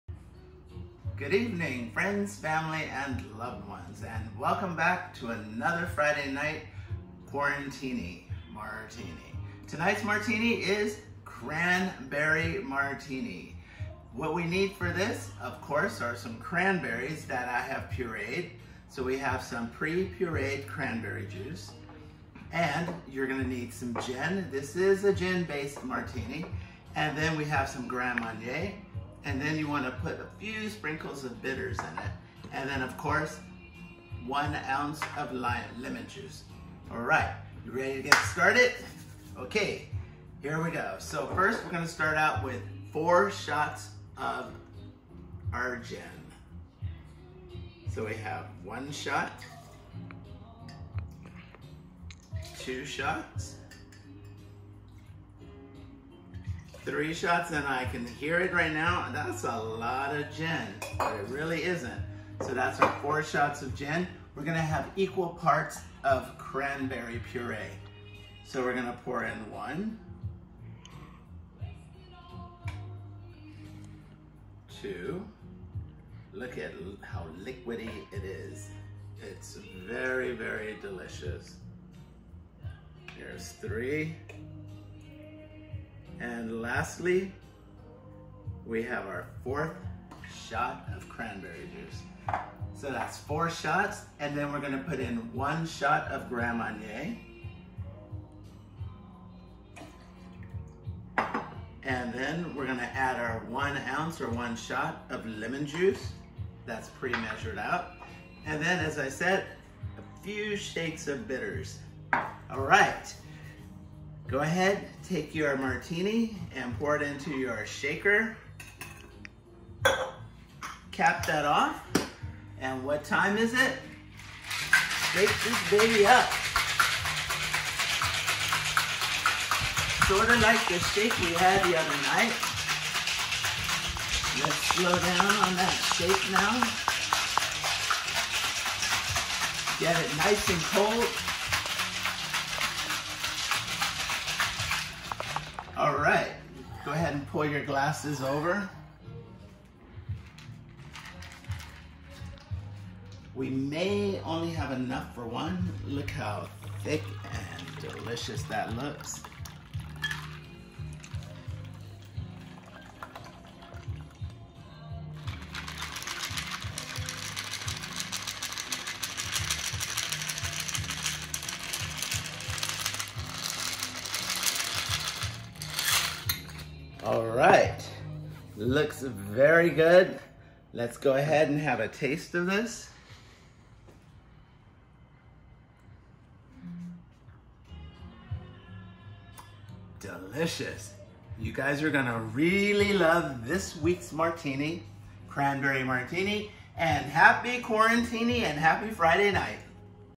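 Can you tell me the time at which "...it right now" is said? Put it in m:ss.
0:58.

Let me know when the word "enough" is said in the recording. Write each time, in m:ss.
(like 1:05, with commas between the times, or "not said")
2:34.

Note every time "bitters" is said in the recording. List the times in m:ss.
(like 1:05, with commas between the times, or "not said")
0:31, 1:51.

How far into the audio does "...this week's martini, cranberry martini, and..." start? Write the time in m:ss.
3:13.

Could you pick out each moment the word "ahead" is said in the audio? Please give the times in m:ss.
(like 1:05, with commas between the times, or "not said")
1:54, 3:01.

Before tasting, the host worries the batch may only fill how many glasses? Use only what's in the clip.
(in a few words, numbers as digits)
1.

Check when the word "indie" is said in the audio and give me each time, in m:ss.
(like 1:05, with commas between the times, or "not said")
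not said.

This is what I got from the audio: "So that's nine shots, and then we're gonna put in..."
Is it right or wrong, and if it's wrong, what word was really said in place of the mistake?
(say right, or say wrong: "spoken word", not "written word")
wrong: "four", not "nine".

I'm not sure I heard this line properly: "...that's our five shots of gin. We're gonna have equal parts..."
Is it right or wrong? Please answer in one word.
wrong.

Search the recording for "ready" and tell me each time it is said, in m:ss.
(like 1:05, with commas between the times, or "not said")
0:37.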